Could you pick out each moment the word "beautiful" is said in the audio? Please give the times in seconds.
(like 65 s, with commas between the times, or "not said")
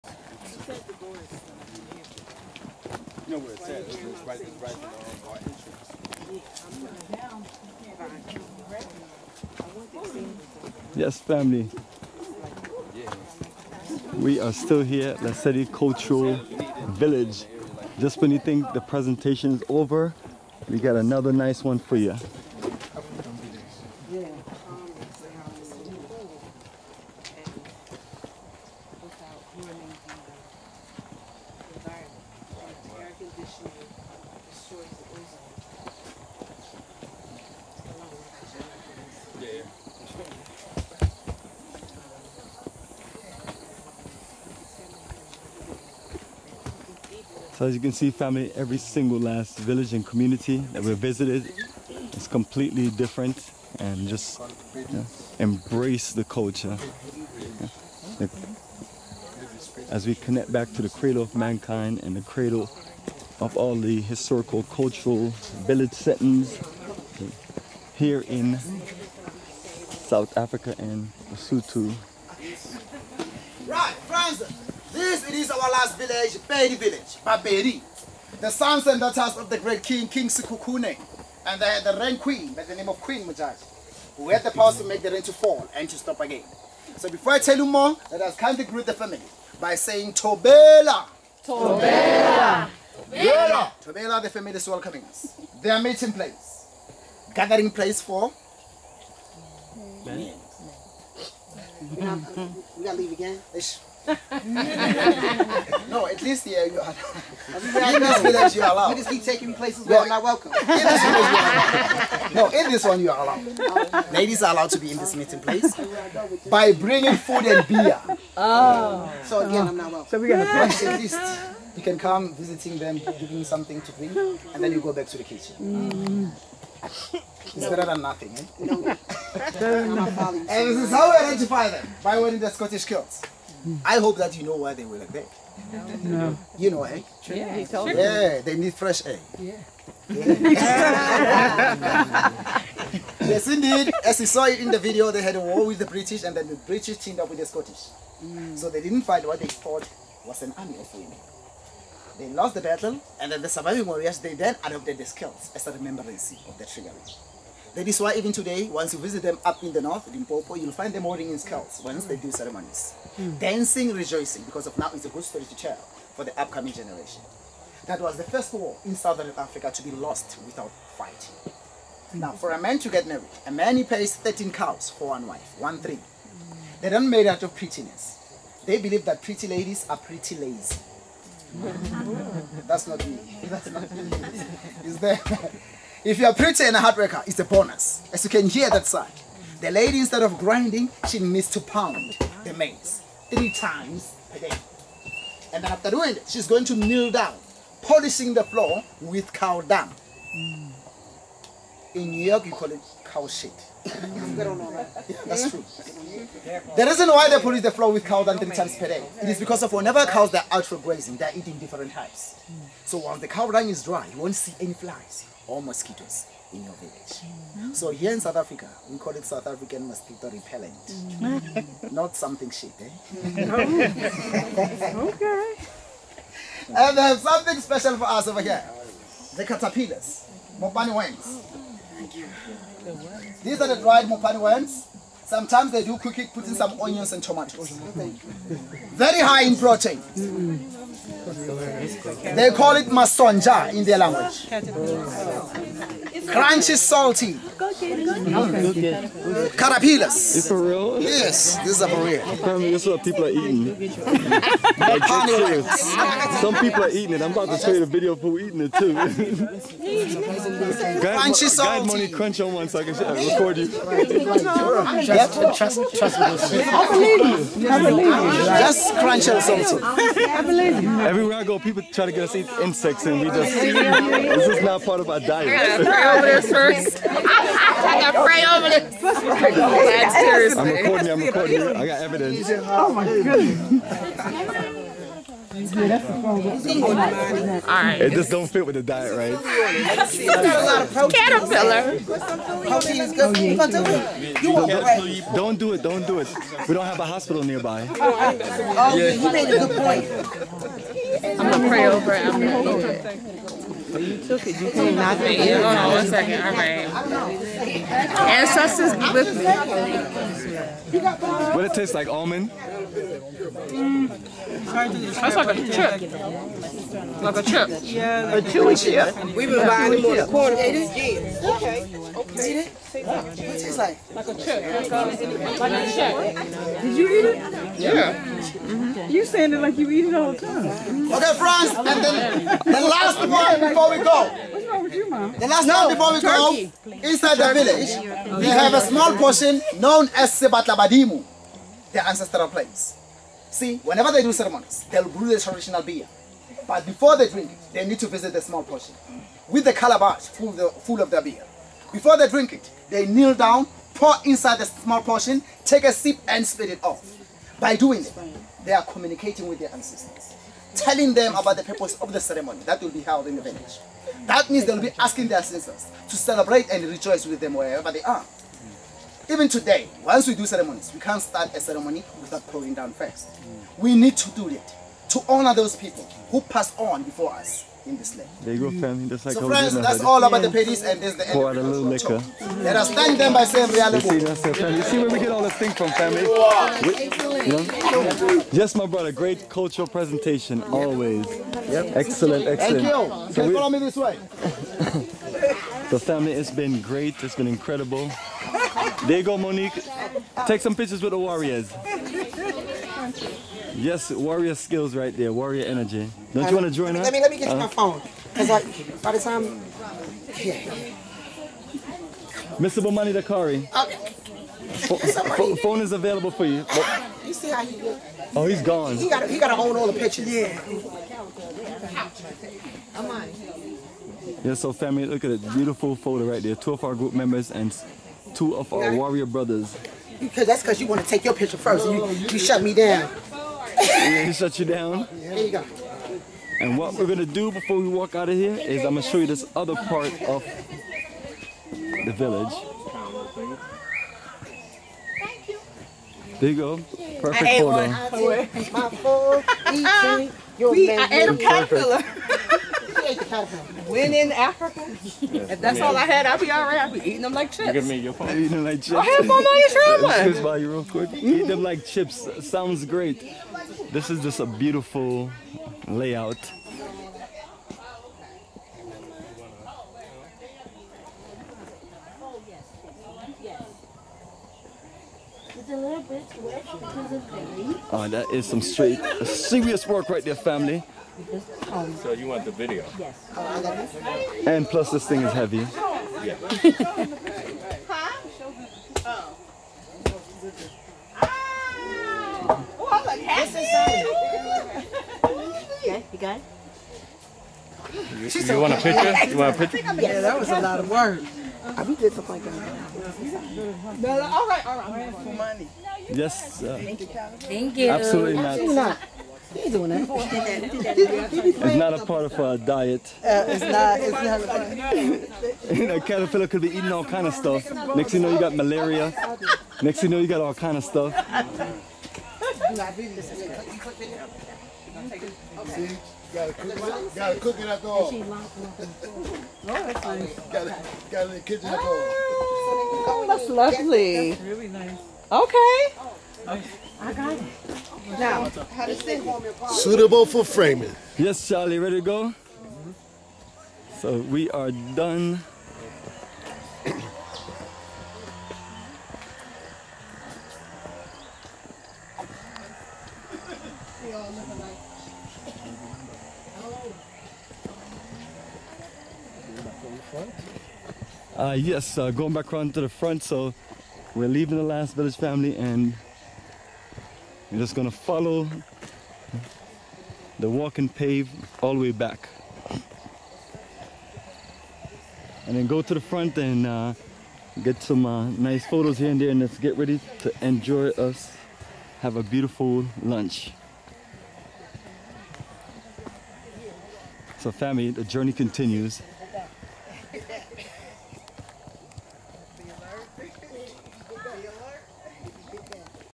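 425 s, 464 s, 582 s.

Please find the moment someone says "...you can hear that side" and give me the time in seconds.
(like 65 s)
188 s.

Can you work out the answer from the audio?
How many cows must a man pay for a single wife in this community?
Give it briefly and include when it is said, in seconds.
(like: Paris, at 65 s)
13, at 174 s.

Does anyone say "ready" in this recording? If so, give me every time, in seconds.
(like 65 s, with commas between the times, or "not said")
541 s, 579 s.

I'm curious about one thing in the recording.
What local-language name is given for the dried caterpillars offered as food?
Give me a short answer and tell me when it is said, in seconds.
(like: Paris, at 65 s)
masonja, at 242 s.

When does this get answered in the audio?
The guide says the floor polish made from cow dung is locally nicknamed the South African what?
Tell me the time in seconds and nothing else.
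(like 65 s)
219 s.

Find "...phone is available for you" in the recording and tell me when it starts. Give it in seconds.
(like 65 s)
415 s.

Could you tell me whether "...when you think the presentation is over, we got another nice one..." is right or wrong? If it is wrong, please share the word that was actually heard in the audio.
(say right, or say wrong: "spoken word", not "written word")
right.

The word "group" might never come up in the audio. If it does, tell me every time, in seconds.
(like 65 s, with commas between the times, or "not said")
426 s.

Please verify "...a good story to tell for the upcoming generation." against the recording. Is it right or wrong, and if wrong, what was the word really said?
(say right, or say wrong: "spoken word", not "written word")
right.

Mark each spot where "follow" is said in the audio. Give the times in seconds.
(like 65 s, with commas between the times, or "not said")
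393 s, 567 s.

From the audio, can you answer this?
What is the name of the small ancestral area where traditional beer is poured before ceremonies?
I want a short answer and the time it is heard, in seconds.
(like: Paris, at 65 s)
Sebatlabadimu, at 340 s.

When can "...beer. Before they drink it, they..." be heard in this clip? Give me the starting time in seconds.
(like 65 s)
351 s.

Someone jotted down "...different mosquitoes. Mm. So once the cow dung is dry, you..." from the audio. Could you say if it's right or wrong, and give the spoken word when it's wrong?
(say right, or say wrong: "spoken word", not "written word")
wrong: "types", not "mosquitoes".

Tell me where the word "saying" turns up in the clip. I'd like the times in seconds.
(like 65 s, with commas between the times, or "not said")
89 s, 329 s, 383 s.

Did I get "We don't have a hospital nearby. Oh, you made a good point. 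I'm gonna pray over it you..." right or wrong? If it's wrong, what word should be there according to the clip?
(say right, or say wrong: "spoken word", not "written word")
right.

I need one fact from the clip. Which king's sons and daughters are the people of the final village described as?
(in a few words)
King Sekhukhune.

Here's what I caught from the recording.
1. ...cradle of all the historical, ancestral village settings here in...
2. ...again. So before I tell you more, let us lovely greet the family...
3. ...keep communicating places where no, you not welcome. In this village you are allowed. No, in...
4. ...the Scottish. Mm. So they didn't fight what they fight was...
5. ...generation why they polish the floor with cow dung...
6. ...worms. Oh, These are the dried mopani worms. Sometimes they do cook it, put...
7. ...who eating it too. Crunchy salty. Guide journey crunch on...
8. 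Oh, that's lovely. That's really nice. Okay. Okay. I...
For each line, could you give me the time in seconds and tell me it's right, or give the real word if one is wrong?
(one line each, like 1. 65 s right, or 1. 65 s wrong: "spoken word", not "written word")
1. 62 s wrong: "cultural", not "ancestral"
2. 86 s wrong: "kindly", not "lovely"
3. 109 s wrong: "taking", not "communicating"
4. 147 s wrong: "thought", not "fight"
5. 206 s wrong: "reason", not "generation"
6. 230 s right
7. 258 s wrong: "money", not "journey"
8. 533 s right.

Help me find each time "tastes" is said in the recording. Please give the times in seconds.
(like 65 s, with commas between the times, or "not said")
311 s, 322 s.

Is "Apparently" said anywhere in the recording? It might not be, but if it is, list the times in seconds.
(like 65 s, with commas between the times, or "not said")
252 s.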